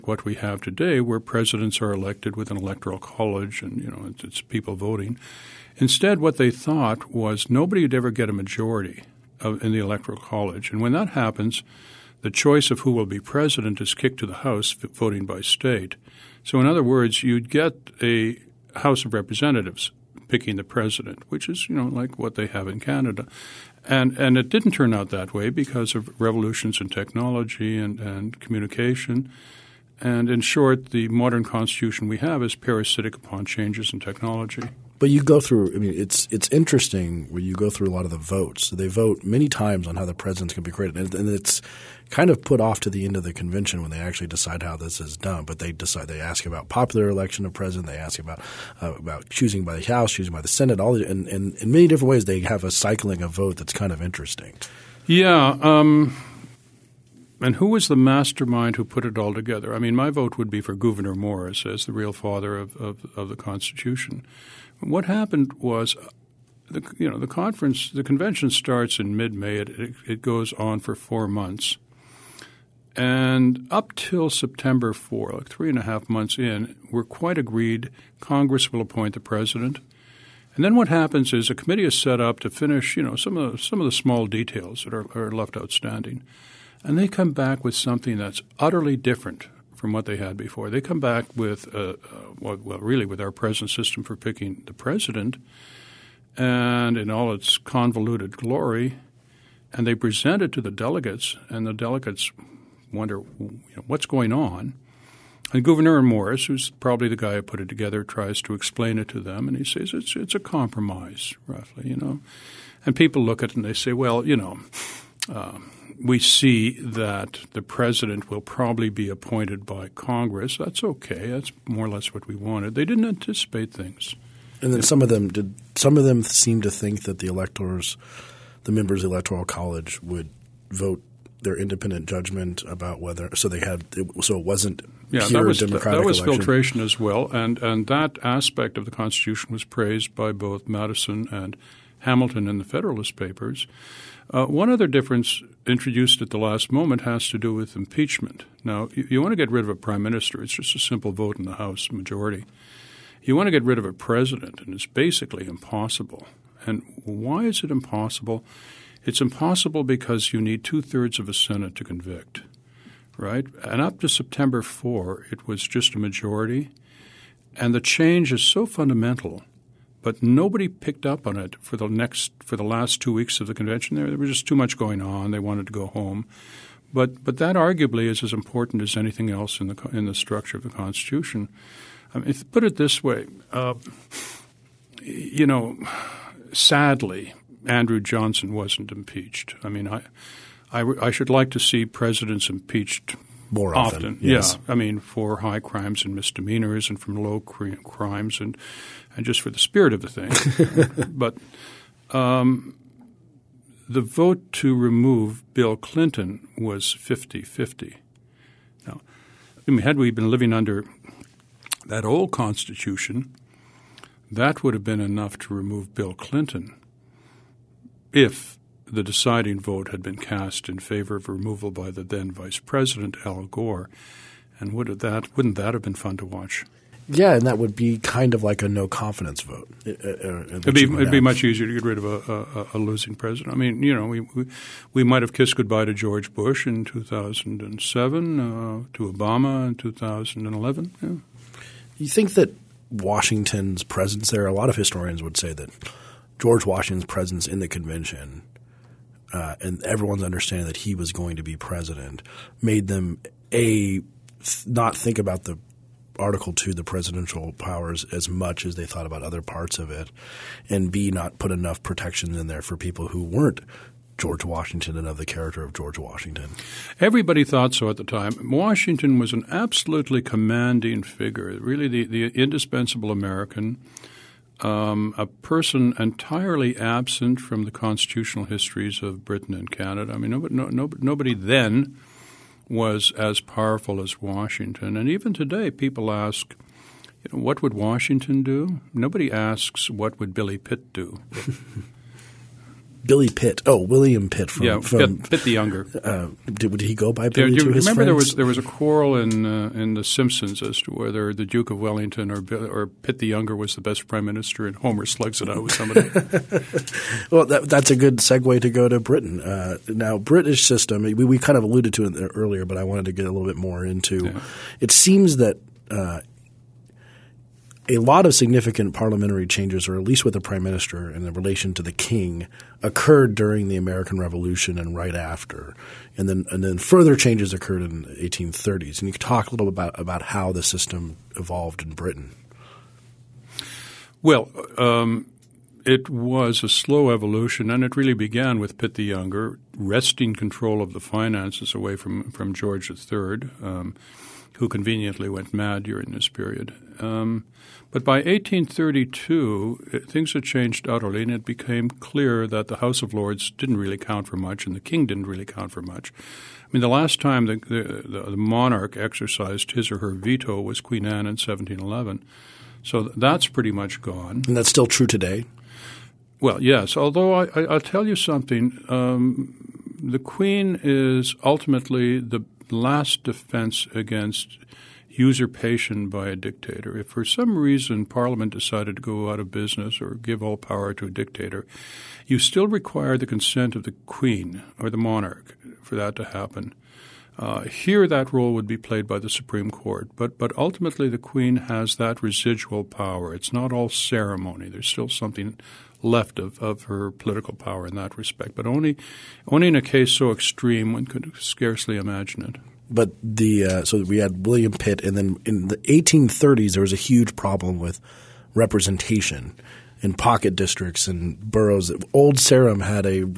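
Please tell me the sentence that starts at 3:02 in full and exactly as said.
I mean, if, put it this way, uh, you know, sadly, Andrew Johnson wasn't impeached.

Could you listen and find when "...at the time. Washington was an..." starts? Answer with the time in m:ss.
4:27.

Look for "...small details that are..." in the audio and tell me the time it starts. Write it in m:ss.
1:23.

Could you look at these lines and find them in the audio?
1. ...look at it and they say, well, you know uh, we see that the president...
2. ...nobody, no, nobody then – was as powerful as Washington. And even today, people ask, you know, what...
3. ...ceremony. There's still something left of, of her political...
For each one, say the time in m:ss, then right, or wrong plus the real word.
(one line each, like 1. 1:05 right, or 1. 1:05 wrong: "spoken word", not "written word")
1. 1:53 right
2. 4:40 right
3. 6:33 right.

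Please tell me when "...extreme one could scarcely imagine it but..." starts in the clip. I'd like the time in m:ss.
6:40.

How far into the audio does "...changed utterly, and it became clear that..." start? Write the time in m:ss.
5:50.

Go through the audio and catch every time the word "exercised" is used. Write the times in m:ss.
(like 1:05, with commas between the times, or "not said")
5:58.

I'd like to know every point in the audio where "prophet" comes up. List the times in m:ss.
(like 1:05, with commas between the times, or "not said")
not said.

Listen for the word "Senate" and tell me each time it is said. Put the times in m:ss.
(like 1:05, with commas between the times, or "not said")
0:50, 2:41.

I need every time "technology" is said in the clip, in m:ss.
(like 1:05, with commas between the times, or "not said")
0:26, 0:33.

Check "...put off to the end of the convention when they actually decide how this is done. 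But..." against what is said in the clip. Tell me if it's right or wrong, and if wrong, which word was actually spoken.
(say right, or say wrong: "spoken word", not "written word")
right.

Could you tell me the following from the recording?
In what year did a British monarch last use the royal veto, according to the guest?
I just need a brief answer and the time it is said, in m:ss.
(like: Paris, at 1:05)
1711, at 6:01.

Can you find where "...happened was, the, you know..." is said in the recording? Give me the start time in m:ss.
1:05.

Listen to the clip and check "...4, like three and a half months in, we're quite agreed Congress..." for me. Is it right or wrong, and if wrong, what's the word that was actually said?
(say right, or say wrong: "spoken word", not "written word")
right.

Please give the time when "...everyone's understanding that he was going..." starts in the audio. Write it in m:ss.
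4:09.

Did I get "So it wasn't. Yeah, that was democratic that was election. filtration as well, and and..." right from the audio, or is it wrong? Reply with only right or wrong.
right.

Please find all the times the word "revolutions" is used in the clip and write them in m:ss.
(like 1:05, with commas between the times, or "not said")
0:26, 5:24.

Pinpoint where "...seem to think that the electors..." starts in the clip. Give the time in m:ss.
2:06.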